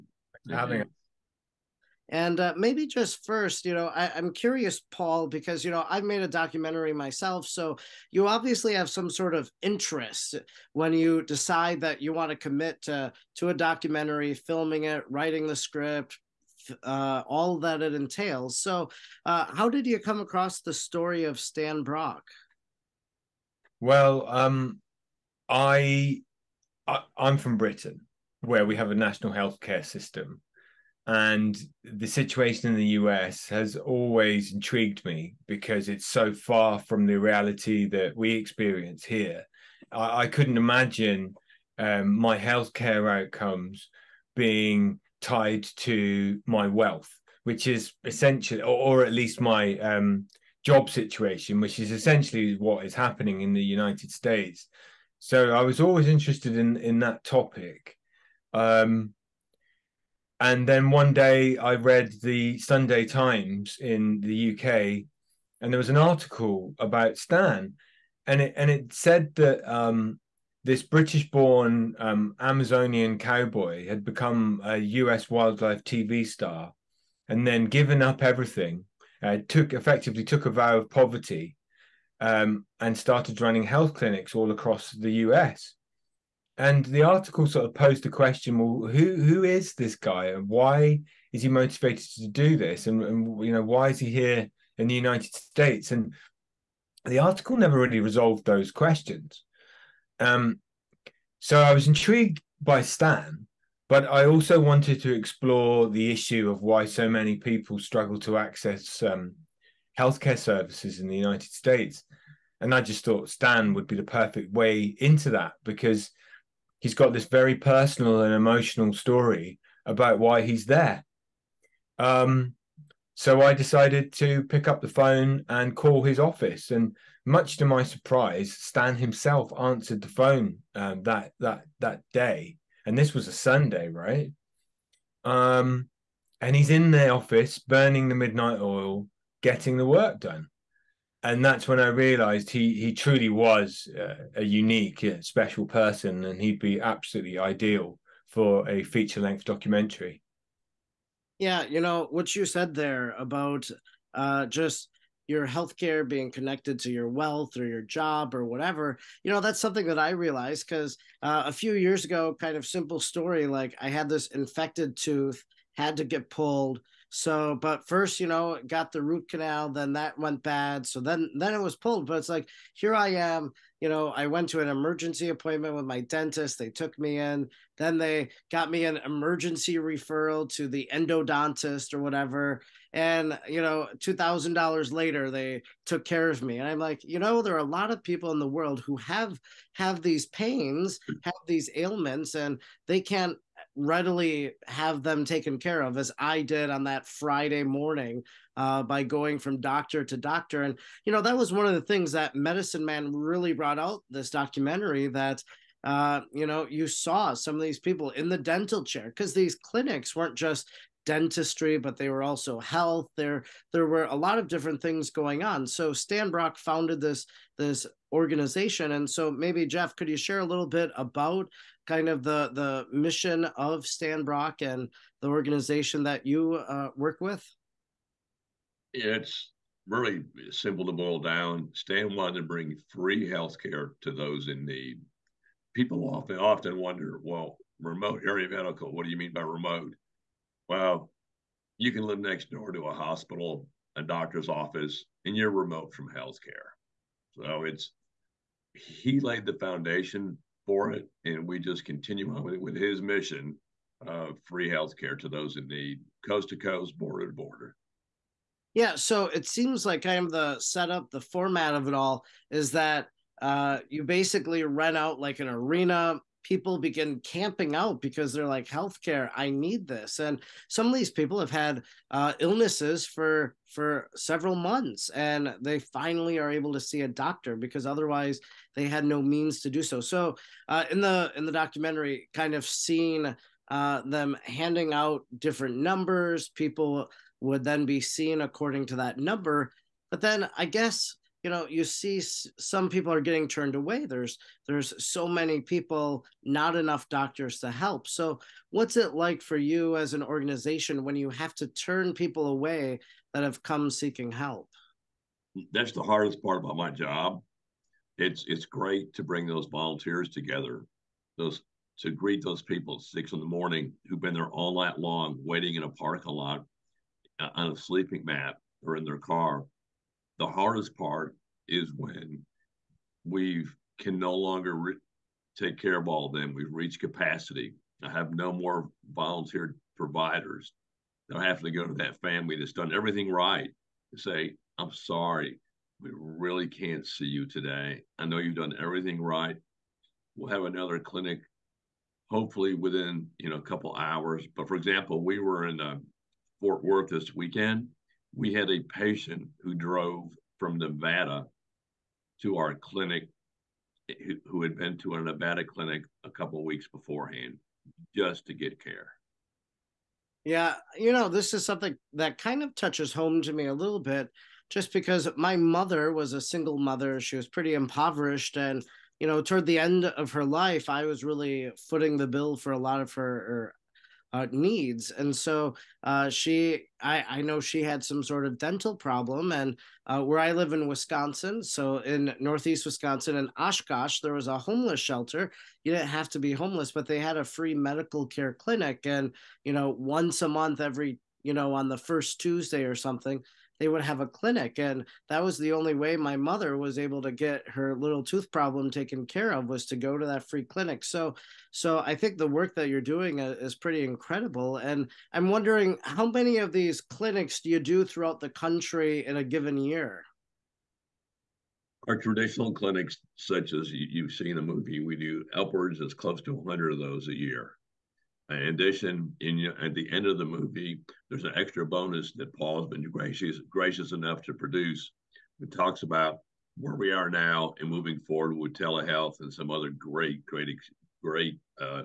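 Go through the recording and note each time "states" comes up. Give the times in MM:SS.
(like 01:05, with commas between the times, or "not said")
00:54, 01:35, 01:51.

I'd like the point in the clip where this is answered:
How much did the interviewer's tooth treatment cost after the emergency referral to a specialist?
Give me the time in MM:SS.
03:03.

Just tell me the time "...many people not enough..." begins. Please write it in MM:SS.
04:55.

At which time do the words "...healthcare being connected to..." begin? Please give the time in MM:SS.
02:35.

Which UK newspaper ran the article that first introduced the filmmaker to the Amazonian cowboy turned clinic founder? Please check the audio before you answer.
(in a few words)
The Sunday Times.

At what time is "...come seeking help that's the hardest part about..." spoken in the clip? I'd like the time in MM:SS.
05:03.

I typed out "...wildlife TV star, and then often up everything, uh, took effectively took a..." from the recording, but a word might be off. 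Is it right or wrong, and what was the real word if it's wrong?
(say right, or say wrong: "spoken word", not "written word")
wrong: "given", not "often".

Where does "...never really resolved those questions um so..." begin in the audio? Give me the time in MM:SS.
01:37.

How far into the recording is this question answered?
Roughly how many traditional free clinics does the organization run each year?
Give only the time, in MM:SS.
06:56.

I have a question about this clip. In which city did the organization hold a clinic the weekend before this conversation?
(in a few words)
Fort Worth.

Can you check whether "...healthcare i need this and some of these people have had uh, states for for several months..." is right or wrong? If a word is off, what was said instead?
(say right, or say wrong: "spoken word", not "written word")
wrong: "illnesses", not "states".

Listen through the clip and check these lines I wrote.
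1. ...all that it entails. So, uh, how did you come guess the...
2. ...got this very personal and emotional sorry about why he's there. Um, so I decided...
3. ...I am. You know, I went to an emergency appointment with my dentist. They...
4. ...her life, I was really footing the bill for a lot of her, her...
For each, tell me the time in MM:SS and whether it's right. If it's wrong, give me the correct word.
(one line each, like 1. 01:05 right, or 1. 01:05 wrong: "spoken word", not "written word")
1. 00:17 wrong: "across", not "guess"
2. 01:56 wrong: "story", not "sorry"
3. 02:52 right
4. 06:10 right.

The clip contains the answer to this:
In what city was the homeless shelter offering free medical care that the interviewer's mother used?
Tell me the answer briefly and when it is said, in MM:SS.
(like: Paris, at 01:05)
Oshkosh, at 06:23.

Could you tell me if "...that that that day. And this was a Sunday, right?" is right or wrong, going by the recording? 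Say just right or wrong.
right.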